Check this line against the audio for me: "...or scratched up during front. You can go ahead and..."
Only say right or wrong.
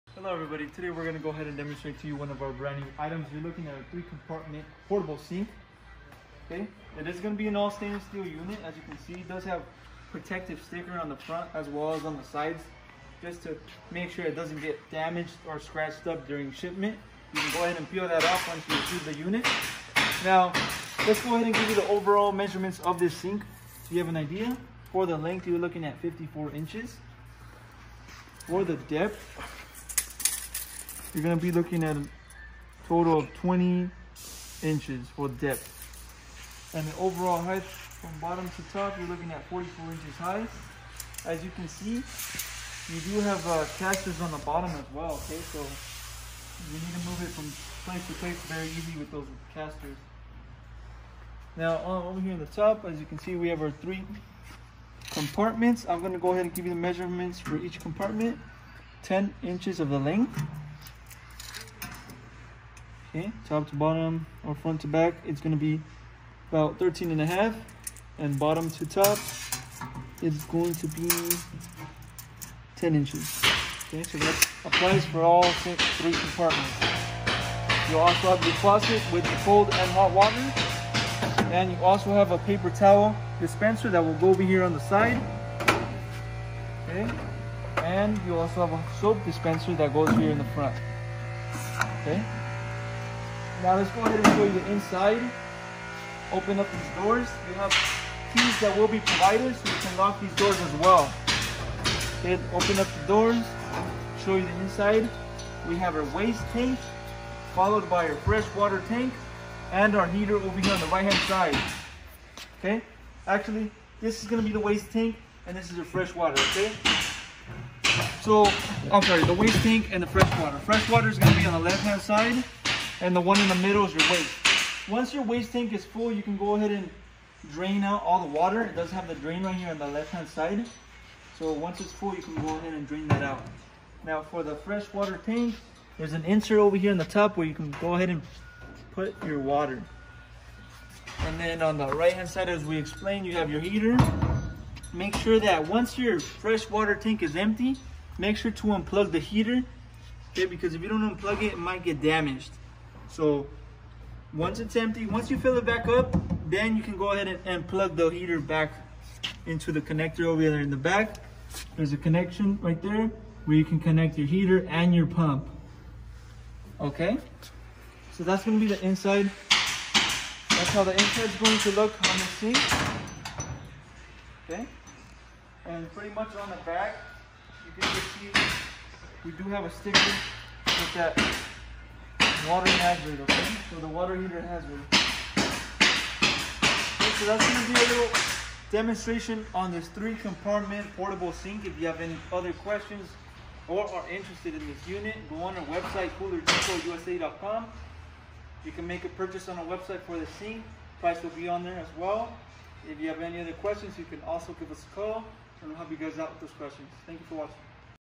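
wrong.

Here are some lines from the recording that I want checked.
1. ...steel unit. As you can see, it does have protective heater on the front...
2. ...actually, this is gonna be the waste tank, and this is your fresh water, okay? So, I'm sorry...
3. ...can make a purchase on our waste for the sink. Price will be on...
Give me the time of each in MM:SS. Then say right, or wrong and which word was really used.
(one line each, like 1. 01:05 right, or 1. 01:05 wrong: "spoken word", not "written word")
1. 00:08 wrong: "sticker", not "heater"
2. 01:53 right
3. 03:18 wrong: "website", not "waste".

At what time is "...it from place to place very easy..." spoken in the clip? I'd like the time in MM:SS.
00:47.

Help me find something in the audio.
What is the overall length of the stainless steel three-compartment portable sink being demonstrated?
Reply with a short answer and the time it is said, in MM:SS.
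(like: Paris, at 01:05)
54 inches, at 00:25.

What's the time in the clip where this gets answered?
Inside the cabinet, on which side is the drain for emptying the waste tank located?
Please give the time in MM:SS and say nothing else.
02:09.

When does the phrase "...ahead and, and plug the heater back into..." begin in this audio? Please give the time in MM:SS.
02:37.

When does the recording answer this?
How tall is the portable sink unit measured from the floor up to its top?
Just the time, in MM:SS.
00:39.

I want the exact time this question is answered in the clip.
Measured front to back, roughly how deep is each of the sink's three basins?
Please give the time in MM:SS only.
01:06.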